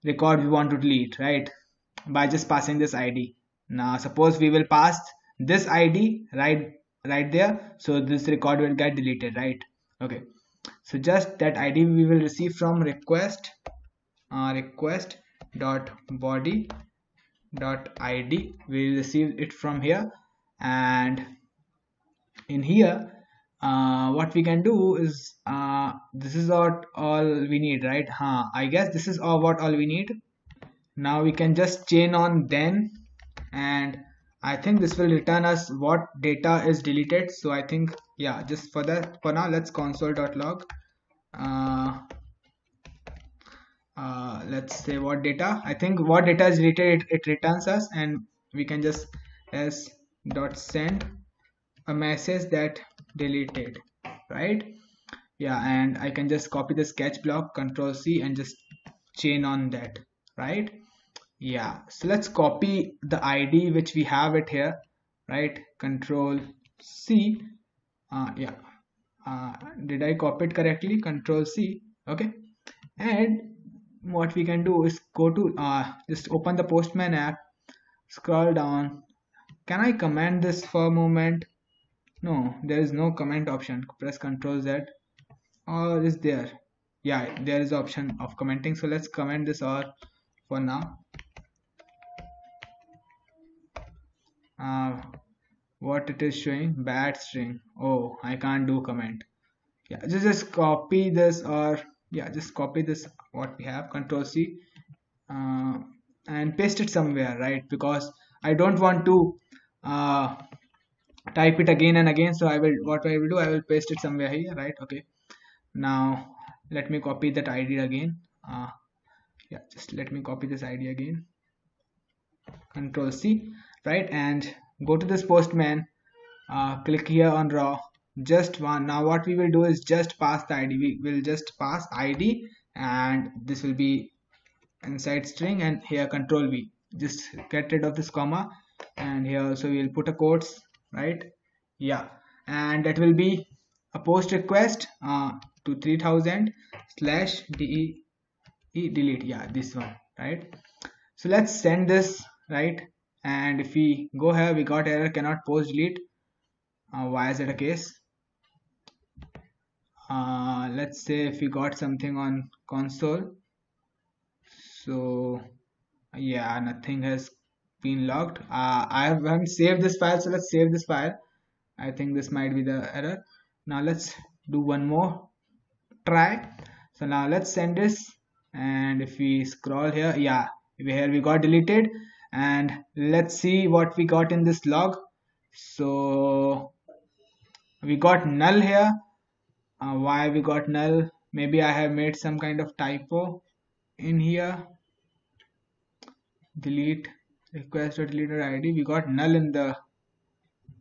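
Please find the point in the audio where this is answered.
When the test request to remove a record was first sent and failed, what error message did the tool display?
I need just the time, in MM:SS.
02:35.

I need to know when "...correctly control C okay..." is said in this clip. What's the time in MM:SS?
01:10.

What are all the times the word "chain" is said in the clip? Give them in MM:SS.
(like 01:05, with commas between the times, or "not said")
00:31, 00:59.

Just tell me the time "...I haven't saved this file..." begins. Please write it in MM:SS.
02:48.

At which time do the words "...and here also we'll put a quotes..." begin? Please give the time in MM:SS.
02:18.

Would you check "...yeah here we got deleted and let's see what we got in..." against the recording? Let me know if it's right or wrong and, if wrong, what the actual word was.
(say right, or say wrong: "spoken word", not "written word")
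right.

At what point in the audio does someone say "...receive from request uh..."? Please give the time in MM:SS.
00:12.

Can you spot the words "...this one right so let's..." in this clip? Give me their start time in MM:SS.
02:29.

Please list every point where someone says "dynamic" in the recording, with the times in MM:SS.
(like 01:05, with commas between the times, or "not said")
not said.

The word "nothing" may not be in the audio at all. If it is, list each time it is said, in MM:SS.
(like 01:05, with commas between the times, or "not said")
02:46.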